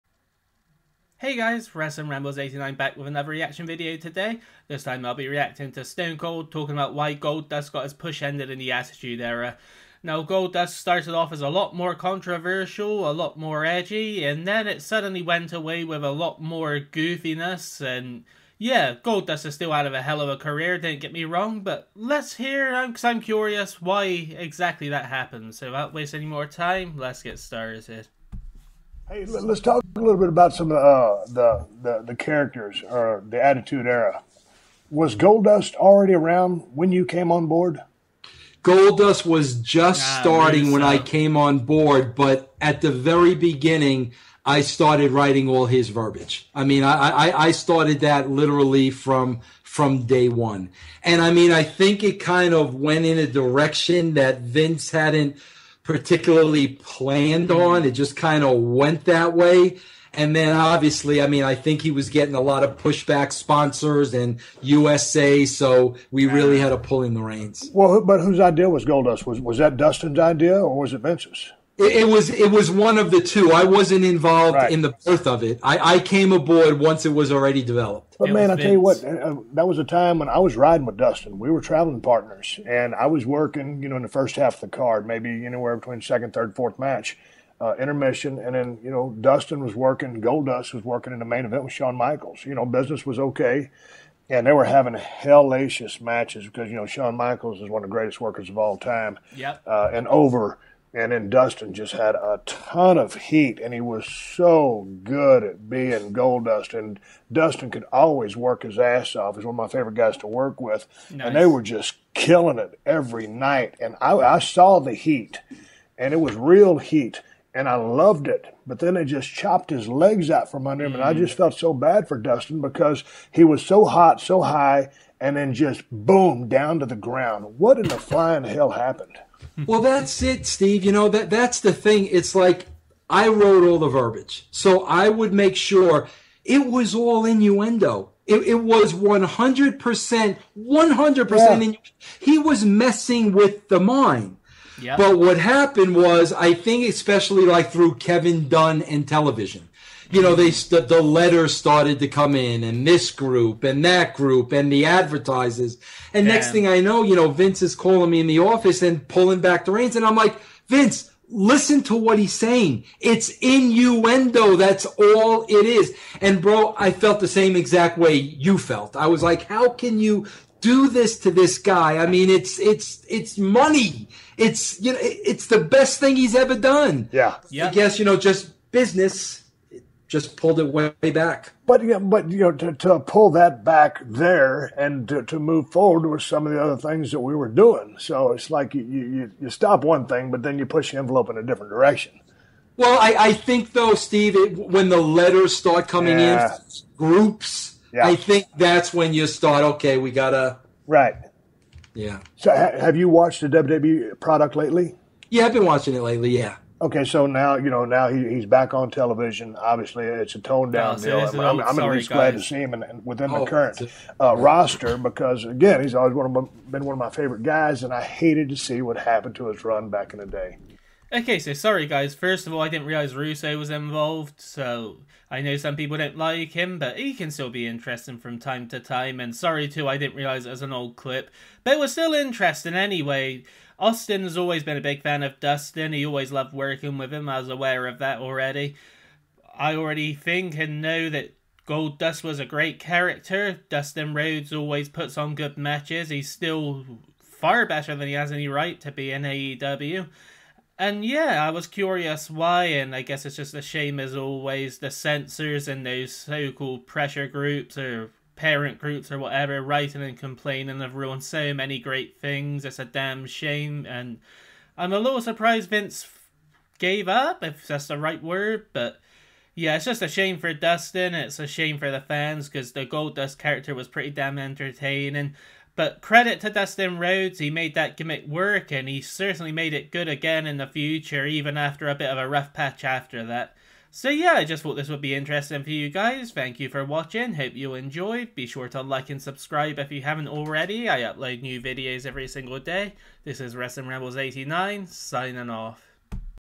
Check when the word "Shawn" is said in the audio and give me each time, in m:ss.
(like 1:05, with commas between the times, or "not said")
1:31, 1:36.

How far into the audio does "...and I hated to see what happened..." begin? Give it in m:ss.
3:37.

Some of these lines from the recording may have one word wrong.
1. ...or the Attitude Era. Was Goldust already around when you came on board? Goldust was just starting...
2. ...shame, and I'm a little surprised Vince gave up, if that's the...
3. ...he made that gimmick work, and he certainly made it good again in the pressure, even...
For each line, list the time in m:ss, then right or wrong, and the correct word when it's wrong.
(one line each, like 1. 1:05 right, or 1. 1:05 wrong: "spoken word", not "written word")
1. 0:32 right
2. 4:23 right
3. 4:37 wrong: "future", not "pressure".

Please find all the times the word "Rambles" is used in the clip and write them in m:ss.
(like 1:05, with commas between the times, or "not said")
0:02, 4:53.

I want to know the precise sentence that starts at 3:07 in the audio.
So it's like you, you, you stop one thing, but then you push the envelope in a different direction.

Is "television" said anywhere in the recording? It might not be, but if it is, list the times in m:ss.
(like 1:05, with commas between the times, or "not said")
2:29, 3:28.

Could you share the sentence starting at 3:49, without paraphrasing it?
And sorry too, I didn't realize it was an old clip, but it was still interesting anyway.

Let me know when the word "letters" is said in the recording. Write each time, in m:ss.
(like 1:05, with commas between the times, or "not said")
2:31, 3:14.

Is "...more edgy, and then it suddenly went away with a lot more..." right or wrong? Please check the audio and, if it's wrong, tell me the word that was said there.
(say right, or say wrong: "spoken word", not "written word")
right.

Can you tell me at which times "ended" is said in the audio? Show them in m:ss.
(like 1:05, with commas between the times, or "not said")
0:08.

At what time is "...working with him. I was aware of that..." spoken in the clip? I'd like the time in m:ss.
3:56.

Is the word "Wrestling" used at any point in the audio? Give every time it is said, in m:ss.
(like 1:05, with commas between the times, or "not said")
0:01, 4:53.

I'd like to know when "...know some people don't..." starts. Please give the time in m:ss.
3:45.